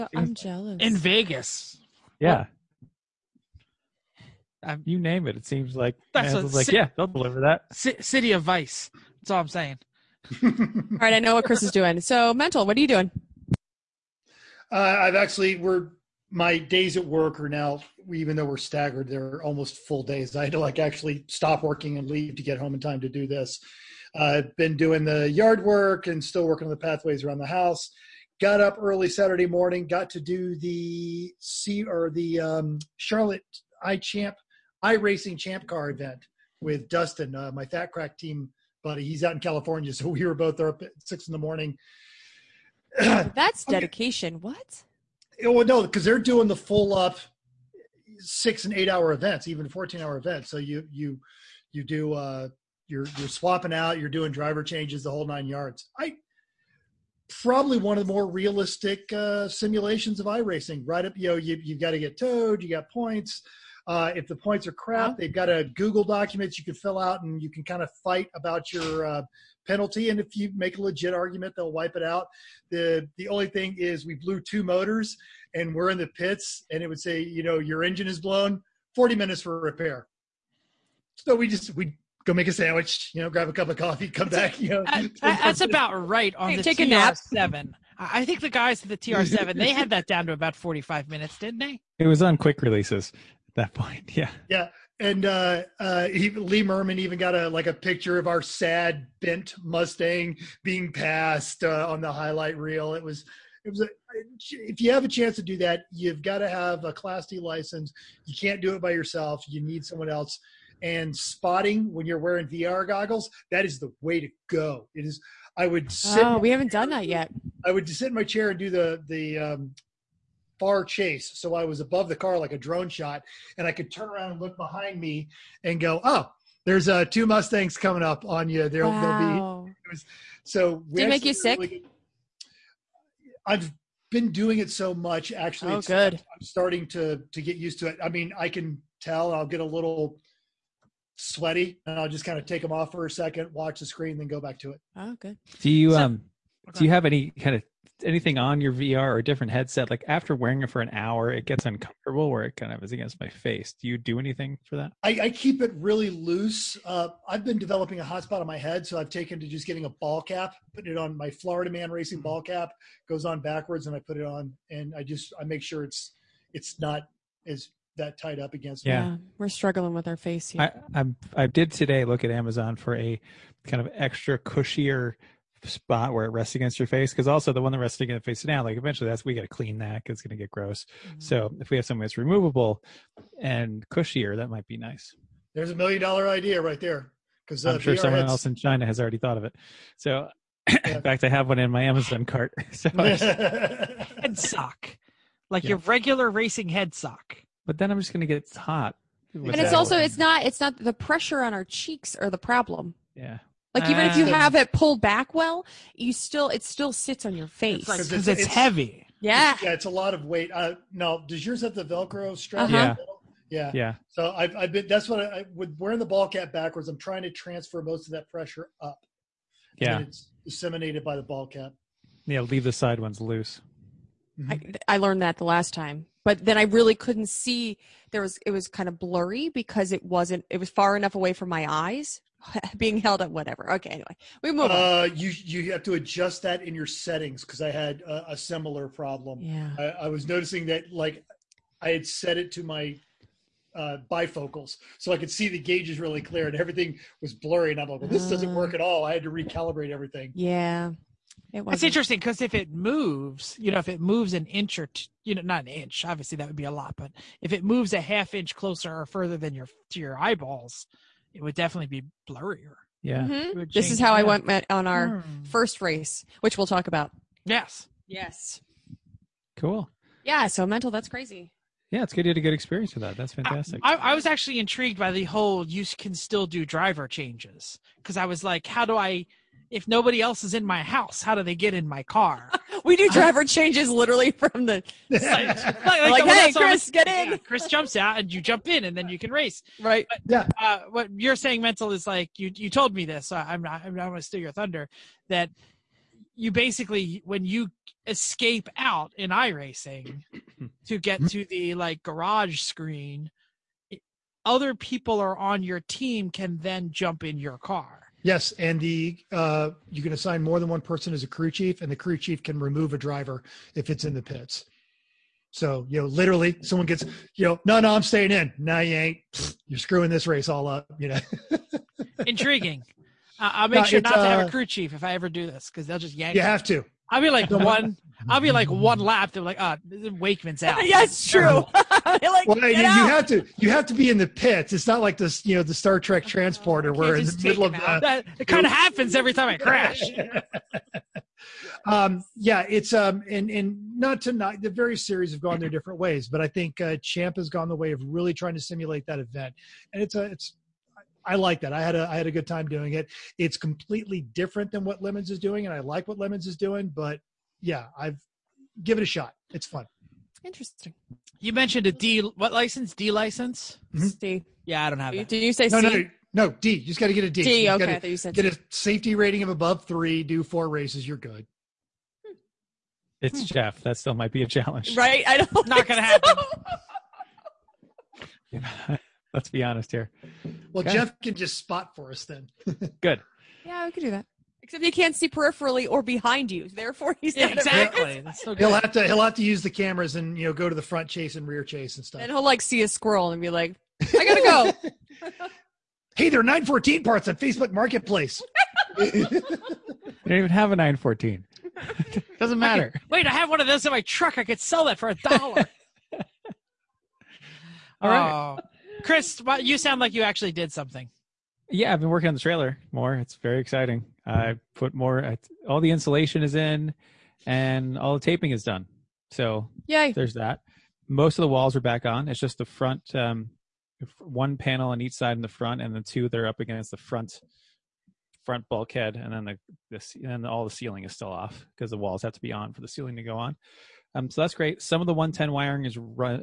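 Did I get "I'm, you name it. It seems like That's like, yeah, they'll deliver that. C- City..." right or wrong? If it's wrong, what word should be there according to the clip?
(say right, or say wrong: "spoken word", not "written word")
right.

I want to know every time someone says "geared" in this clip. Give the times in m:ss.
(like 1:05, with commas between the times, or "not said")
not said.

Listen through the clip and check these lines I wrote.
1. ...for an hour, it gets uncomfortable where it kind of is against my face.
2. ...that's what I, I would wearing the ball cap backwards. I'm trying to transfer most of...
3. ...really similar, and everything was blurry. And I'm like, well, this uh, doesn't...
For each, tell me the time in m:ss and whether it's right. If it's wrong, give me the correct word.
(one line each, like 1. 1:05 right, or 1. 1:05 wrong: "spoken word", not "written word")
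1. 2:30 right
2. 3:34 right
3. 4:05 wrong: "clear", not "similar".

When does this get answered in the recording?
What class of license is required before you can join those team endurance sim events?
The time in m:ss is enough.
1:46.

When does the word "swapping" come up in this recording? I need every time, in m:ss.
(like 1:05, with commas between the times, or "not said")
0:53.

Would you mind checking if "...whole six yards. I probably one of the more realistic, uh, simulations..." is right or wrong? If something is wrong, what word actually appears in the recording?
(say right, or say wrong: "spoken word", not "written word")
wrong: "nine", not "six".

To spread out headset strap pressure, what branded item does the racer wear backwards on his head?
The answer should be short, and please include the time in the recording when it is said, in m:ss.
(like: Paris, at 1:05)
Florida Man Racing ball cap, at 2:41.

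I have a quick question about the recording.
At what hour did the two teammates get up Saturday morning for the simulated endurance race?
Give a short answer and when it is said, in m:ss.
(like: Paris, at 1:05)
6, at 0:41.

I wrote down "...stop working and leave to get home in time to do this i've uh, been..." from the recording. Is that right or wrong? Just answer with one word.
right.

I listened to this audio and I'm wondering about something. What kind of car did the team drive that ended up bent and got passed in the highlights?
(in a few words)
Mustang.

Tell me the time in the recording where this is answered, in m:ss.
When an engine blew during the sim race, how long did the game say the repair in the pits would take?
1:18.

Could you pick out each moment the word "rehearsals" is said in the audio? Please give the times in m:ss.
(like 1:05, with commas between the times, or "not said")
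not said.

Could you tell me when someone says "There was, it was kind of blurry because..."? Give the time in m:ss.
3:48.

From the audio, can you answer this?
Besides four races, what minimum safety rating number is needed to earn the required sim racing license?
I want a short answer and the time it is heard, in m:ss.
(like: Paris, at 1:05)
3, at 6:09.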